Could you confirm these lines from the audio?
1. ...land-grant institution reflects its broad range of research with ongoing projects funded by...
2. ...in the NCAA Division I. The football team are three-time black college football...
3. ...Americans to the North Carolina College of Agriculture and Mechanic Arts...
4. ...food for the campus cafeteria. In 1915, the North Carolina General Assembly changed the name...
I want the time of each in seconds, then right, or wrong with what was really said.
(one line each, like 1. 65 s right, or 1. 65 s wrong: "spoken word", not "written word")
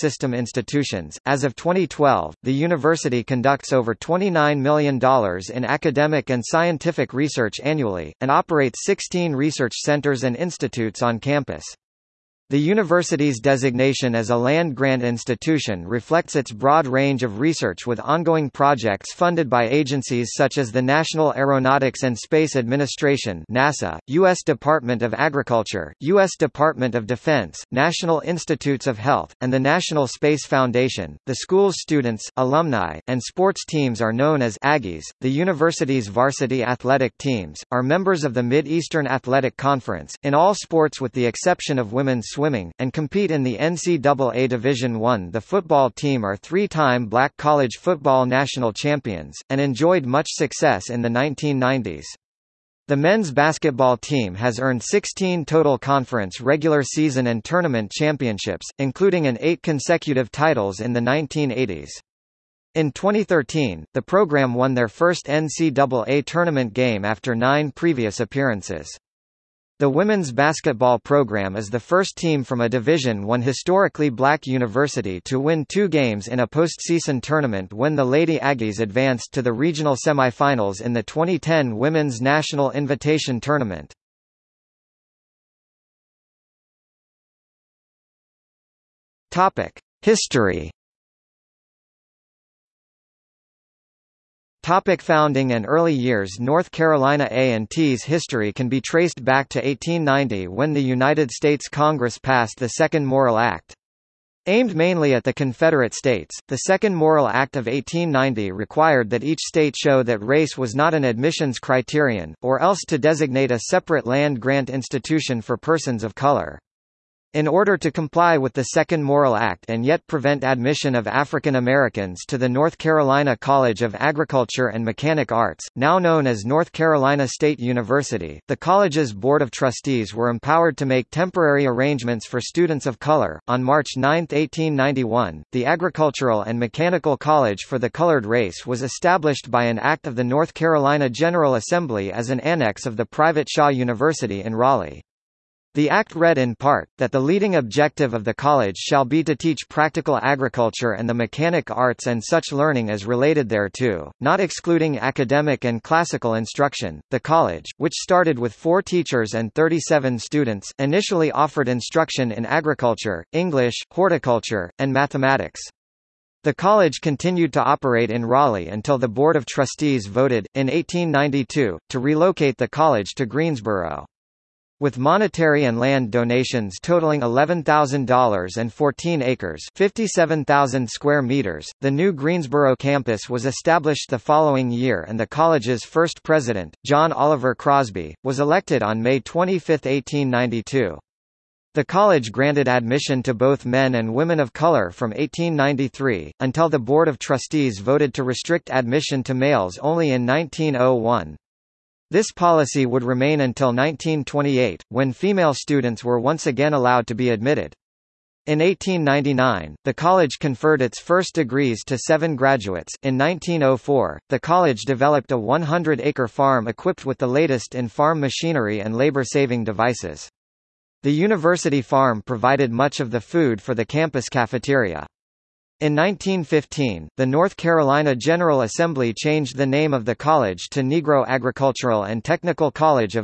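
1. 14 s right
2. 43 s right
3. 121 s right
4. 223 s right.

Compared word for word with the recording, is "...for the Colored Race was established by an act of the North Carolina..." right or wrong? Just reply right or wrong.
right.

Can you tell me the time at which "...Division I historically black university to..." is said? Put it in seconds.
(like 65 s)
72 s.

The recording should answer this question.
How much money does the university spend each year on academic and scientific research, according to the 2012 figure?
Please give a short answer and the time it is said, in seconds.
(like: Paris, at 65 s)
$29 million, at 3 s.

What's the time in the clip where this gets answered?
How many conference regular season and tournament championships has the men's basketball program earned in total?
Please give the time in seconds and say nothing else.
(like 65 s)
54 s.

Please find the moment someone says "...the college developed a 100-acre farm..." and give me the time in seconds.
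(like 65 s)
214 s.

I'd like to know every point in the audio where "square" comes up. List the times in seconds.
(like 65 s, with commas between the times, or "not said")
180 s.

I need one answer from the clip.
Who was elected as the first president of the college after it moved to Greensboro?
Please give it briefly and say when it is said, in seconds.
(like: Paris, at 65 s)
John Oliver Crosby, at 186 s.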